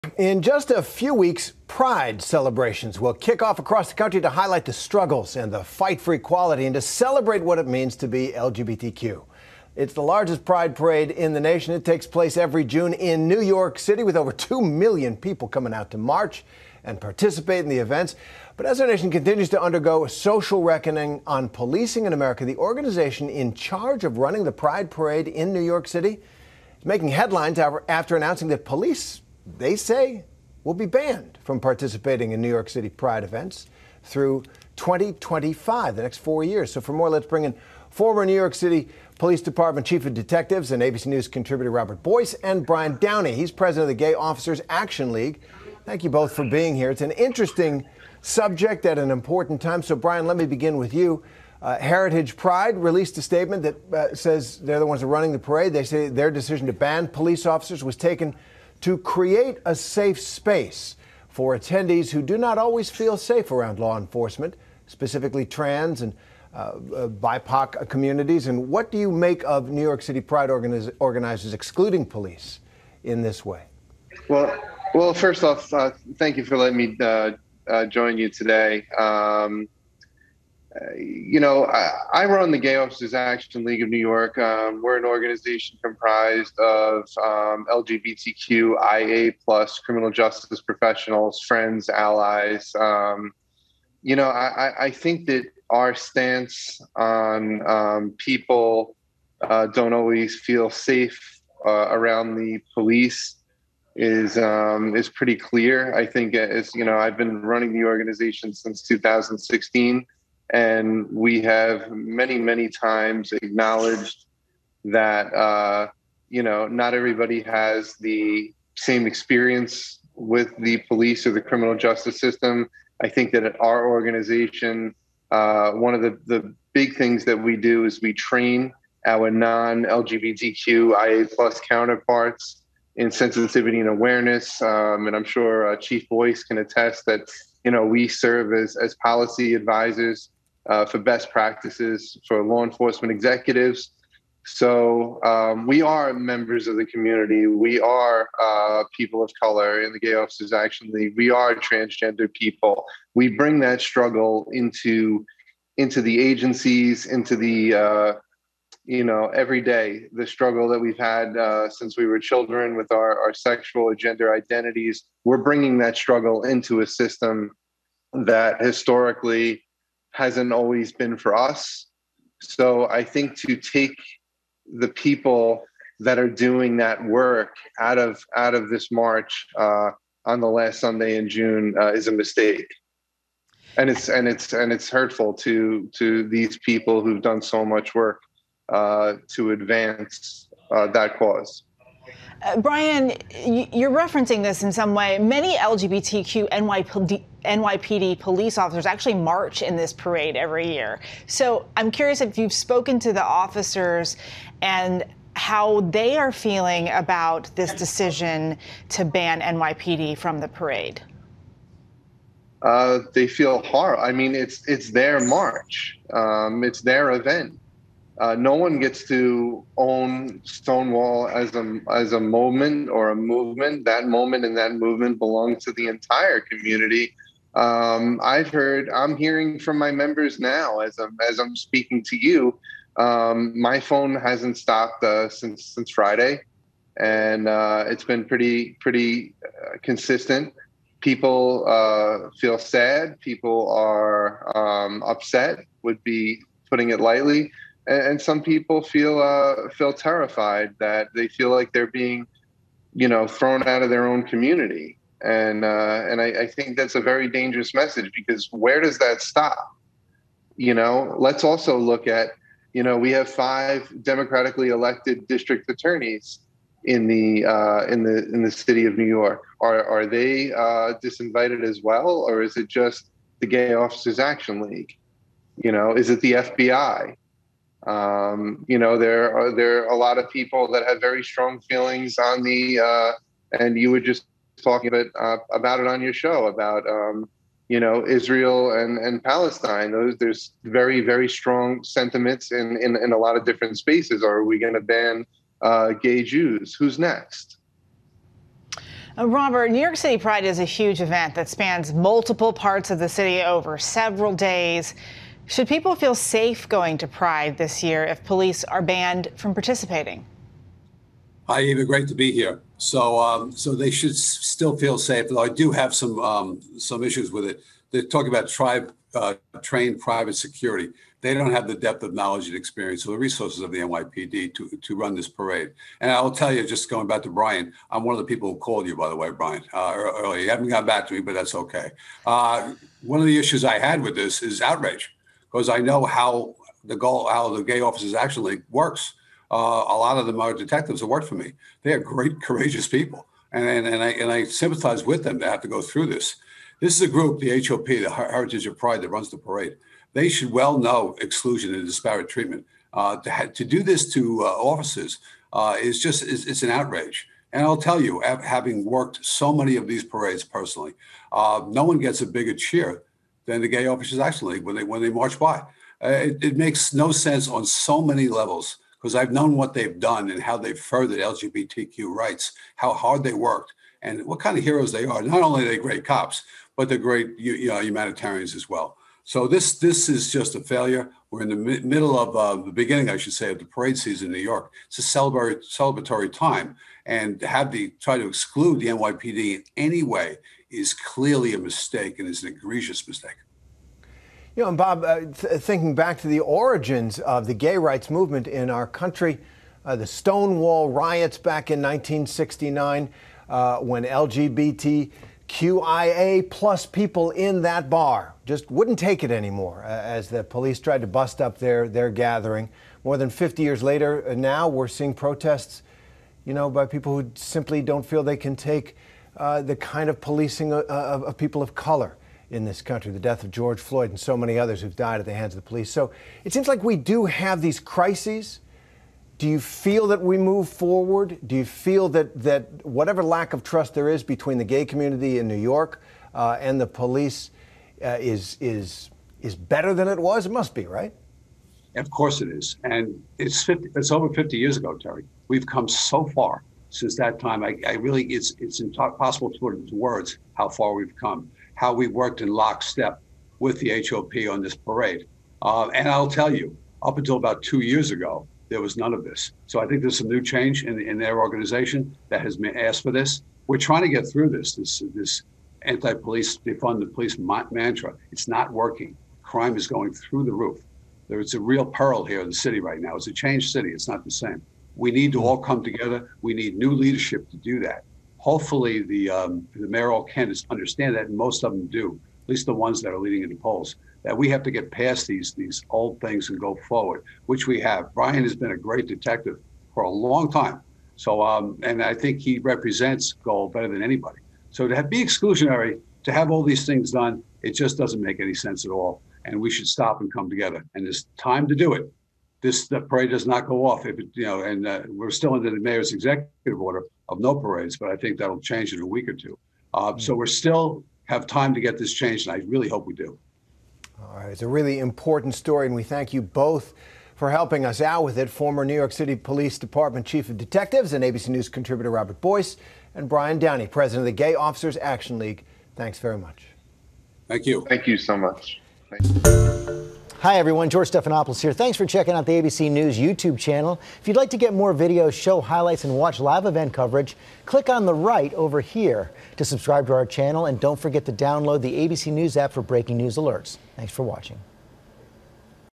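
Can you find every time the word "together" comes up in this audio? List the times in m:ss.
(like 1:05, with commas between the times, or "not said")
7:55, 8:20.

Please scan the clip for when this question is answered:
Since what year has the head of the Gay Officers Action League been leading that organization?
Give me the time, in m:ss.
1:48.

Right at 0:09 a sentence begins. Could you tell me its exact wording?
It's the largest Pride parade in the nation.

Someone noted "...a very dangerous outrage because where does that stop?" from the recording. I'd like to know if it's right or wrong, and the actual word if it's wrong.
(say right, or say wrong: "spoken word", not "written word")
wrong: "message", not "outrage".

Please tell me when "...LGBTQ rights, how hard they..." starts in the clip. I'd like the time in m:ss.
6:11.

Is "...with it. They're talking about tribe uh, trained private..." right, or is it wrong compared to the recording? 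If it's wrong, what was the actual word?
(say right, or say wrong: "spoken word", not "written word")
right.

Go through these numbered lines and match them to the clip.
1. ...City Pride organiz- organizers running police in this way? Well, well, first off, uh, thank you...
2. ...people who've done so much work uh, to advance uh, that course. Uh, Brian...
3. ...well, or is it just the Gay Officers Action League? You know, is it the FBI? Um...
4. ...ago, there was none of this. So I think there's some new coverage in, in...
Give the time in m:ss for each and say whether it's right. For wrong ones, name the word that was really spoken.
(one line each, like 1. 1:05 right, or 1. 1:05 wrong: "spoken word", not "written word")
1. 1:10 wrong: "excluding", not "running"
2. 3:06 wrong: "cause", not "course"
3. 4:31 right
4. 7:38 wrong: "change", not "coverage".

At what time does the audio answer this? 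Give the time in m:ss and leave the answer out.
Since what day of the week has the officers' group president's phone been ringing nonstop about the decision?
3:55.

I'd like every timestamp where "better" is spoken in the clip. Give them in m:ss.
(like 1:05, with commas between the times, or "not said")
7:19, 8:13.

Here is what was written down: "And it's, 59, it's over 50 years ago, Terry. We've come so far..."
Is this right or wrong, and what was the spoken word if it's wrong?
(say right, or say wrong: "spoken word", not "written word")
wrong: "50", not "59".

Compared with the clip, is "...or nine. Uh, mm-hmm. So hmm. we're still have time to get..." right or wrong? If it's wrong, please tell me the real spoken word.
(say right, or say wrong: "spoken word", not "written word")
wrong: "two", not "nine".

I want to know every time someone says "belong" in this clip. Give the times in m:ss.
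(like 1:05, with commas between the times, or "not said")
3:45.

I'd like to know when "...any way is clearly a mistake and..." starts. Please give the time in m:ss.
6:29.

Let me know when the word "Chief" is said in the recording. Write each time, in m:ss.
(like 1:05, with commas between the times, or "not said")
0:39, 2:15, 8:40.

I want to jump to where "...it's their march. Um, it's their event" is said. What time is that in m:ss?
3:34.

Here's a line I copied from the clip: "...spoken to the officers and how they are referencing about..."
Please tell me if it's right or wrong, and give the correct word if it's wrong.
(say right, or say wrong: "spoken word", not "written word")
wrong: "feeling", not "referencing".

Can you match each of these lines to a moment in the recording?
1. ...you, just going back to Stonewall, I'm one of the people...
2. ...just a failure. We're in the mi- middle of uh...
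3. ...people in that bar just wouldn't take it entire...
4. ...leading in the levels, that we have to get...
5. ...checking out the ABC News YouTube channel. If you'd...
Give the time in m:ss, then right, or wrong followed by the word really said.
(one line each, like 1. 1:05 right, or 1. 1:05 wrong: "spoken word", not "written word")
1. 5:26 wrong: "Brian", not "Stonewall"
2. 6:20 right
3. 6:46 wrong: "anymore", not "entire"
4. 8:03 wrong: "polls", not "levels"
5. 8:52 right.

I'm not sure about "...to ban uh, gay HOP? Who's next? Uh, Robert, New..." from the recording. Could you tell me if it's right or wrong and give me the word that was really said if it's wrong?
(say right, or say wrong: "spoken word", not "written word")
wrong: "Jews", not "HOP".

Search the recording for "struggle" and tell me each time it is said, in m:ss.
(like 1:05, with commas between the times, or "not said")
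0:04, 2:33, 2:40, 2:45.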